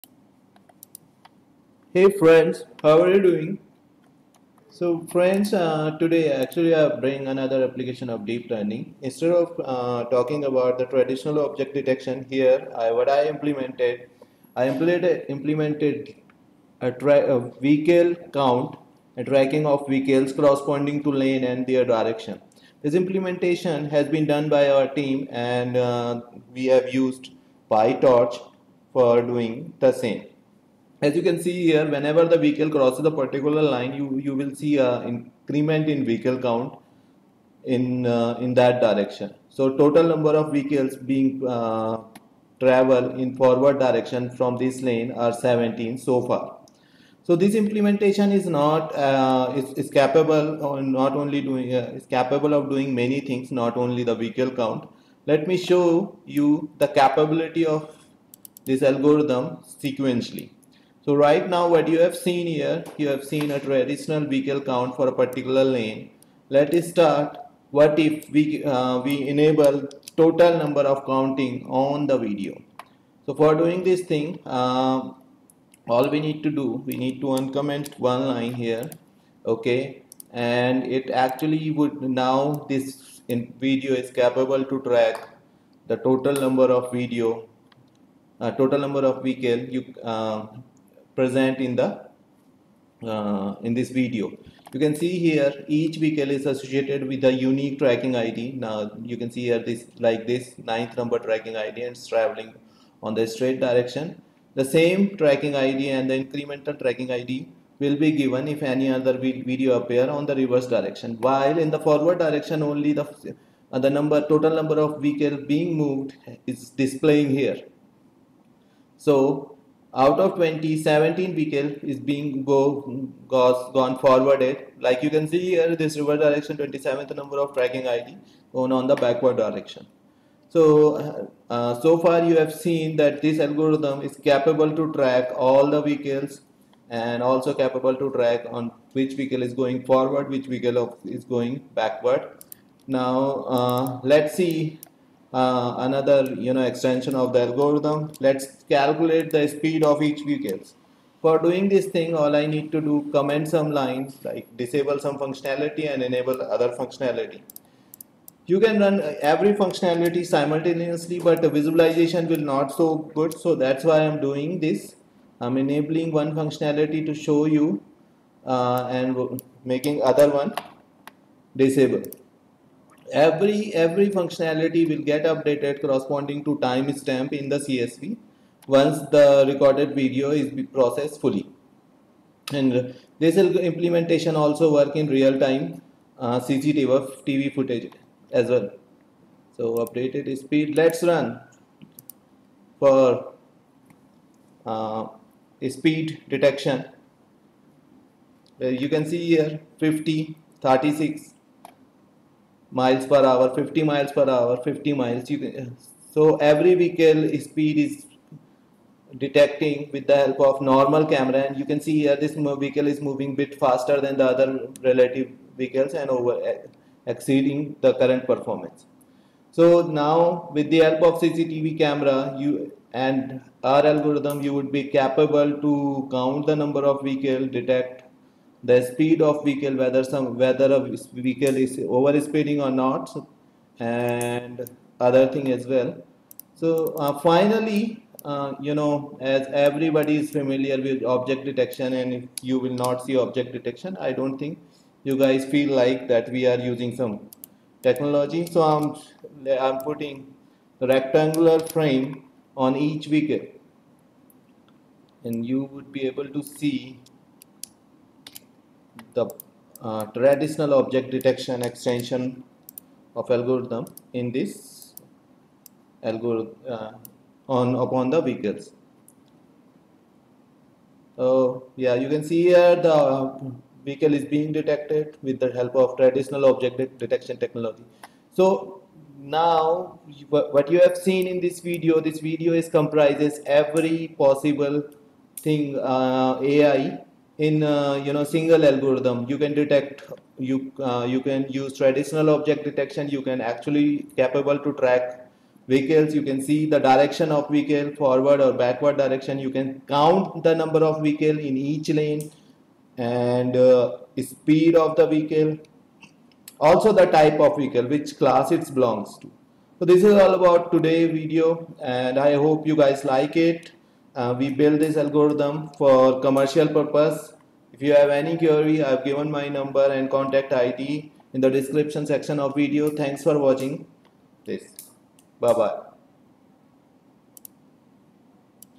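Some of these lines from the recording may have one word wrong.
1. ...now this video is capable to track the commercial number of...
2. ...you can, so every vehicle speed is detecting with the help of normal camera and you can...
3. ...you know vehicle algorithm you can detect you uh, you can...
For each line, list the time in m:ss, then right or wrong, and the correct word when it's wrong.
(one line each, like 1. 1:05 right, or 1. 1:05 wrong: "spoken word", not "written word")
1. 1:22 wrong: "total", not "commercial"
2. 3:25 right
3. 4:48 wrong: "single", not "vehicle".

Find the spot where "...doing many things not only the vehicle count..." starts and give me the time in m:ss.
0:52.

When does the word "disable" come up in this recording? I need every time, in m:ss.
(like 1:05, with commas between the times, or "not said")
2:34, 2:51.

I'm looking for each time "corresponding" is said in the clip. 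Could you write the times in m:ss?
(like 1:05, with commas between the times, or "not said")
0:20, 2:55.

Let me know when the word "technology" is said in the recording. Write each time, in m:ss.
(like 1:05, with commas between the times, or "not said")
4:07, 4:37.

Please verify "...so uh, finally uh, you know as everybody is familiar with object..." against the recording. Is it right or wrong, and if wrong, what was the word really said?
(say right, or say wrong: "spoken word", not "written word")
right.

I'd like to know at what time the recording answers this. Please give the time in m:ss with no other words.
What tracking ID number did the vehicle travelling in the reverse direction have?
2:06.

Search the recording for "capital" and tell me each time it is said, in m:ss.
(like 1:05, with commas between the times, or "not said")
not said.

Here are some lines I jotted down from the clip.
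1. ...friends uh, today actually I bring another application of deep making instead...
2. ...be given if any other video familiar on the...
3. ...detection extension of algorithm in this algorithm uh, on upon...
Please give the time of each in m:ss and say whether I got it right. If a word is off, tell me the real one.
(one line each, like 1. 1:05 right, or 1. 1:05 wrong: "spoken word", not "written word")
1. 0:05 wrong: "learning", not "making"
2. 1:47 wrong: "appear", not "familiar"
3. 4:21 right.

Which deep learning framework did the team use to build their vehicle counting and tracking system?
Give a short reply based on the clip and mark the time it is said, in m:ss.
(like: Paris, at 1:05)
PyTorch, at 0:27.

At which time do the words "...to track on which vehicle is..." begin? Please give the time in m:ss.
2:17.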